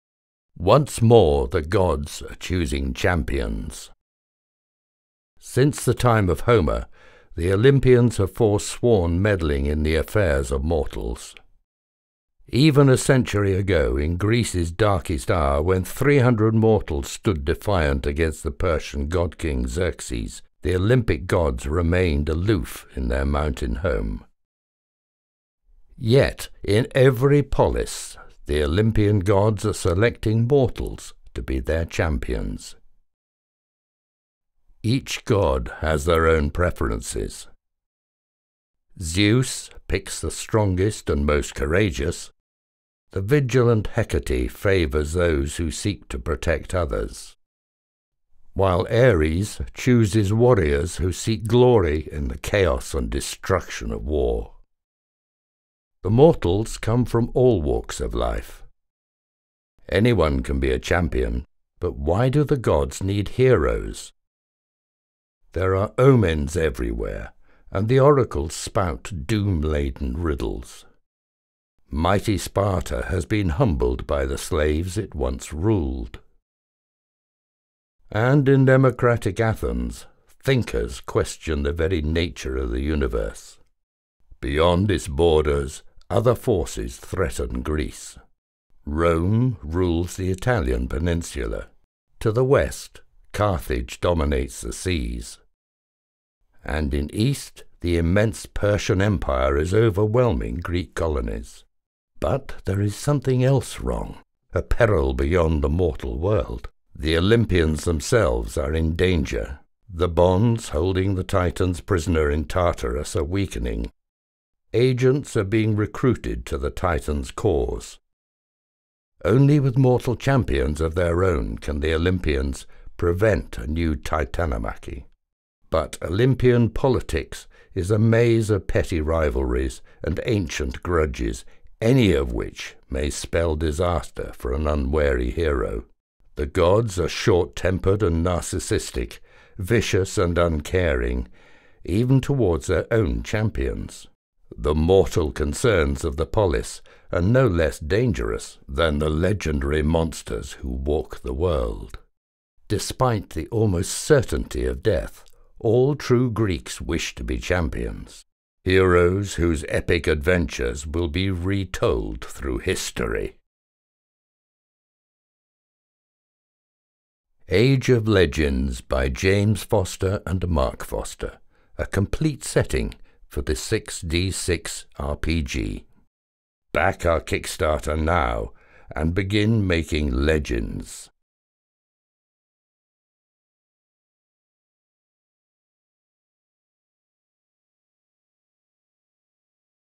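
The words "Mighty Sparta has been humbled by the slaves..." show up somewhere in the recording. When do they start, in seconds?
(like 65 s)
71 s.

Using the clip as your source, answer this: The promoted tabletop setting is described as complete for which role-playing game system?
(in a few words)
6D6.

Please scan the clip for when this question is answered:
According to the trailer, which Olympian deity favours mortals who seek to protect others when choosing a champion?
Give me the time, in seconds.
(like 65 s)
43 s.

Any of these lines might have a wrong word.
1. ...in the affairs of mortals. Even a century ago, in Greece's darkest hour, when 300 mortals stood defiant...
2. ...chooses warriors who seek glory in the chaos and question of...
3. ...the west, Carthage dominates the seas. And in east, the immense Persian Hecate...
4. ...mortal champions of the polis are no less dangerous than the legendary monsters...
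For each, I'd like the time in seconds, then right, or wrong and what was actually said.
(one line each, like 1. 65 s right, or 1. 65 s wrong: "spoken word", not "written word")
1. 9 s right
2. 49 s wrong: "destruction", not "question"
3. 92 s wrong: "Empire", not "Hecate"
4. 144 s wrong: "concerns", not "champions".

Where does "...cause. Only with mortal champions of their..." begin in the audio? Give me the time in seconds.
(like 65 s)
117 s.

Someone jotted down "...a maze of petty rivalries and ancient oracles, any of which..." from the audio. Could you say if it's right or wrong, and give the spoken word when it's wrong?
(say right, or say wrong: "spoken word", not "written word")
wrong: "grudges", not "oracles".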